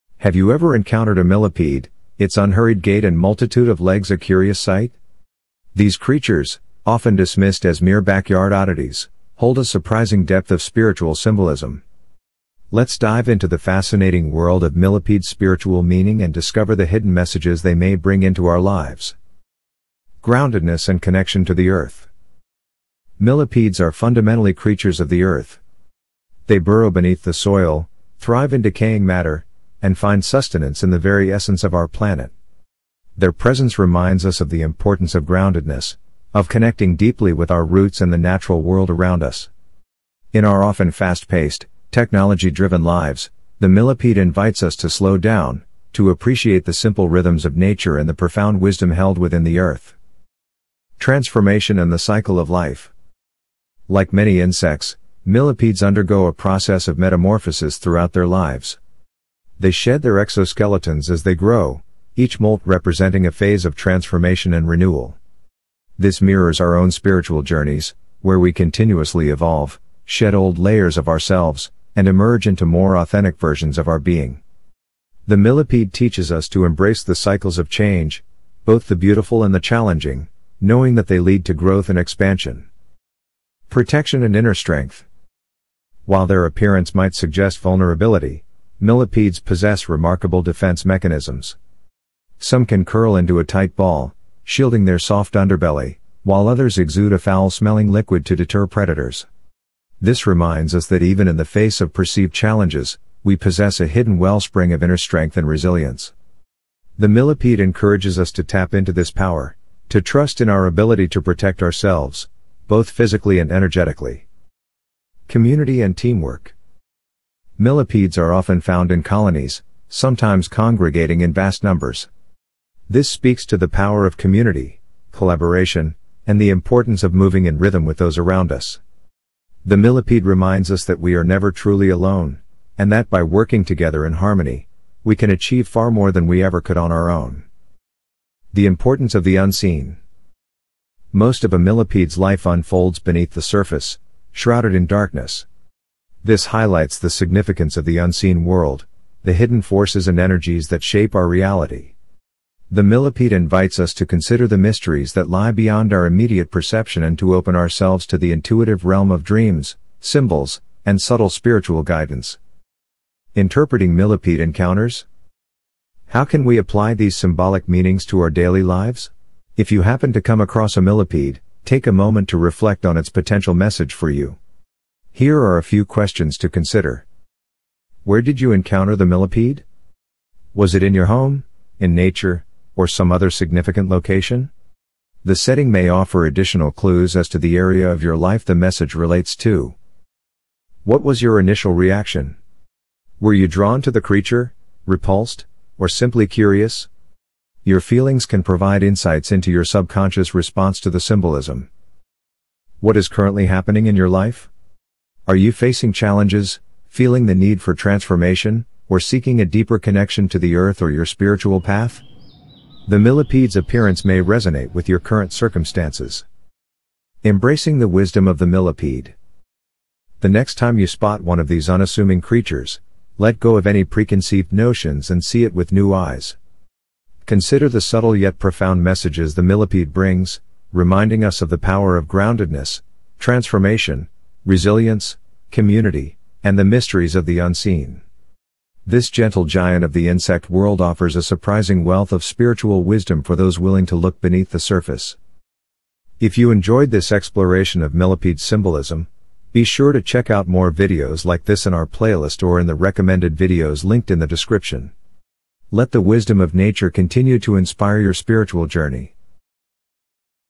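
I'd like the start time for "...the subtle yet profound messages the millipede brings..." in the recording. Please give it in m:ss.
3:47.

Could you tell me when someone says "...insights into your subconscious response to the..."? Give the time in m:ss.
3:18.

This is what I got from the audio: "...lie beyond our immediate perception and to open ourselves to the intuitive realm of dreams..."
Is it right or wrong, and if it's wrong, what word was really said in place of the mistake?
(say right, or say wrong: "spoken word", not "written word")
right.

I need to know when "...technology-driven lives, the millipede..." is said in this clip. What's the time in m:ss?
0:41.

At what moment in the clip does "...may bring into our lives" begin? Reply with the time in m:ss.
0:17.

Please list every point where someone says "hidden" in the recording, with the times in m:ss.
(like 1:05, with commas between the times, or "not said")
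0:16, 1:43, 2:29.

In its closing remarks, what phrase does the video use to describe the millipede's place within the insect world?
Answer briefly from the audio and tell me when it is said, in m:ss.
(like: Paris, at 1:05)
Gentle giant, at 3:59.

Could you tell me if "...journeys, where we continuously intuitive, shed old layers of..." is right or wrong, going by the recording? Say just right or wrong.
wrong.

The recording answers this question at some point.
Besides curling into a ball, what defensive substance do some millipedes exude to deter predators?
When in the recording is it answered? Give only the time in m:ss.
1:37.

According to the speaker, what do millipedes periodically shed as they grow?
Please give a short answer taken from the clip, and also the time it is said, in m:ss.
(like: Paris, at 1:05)
Exoskeletons, at 1:00.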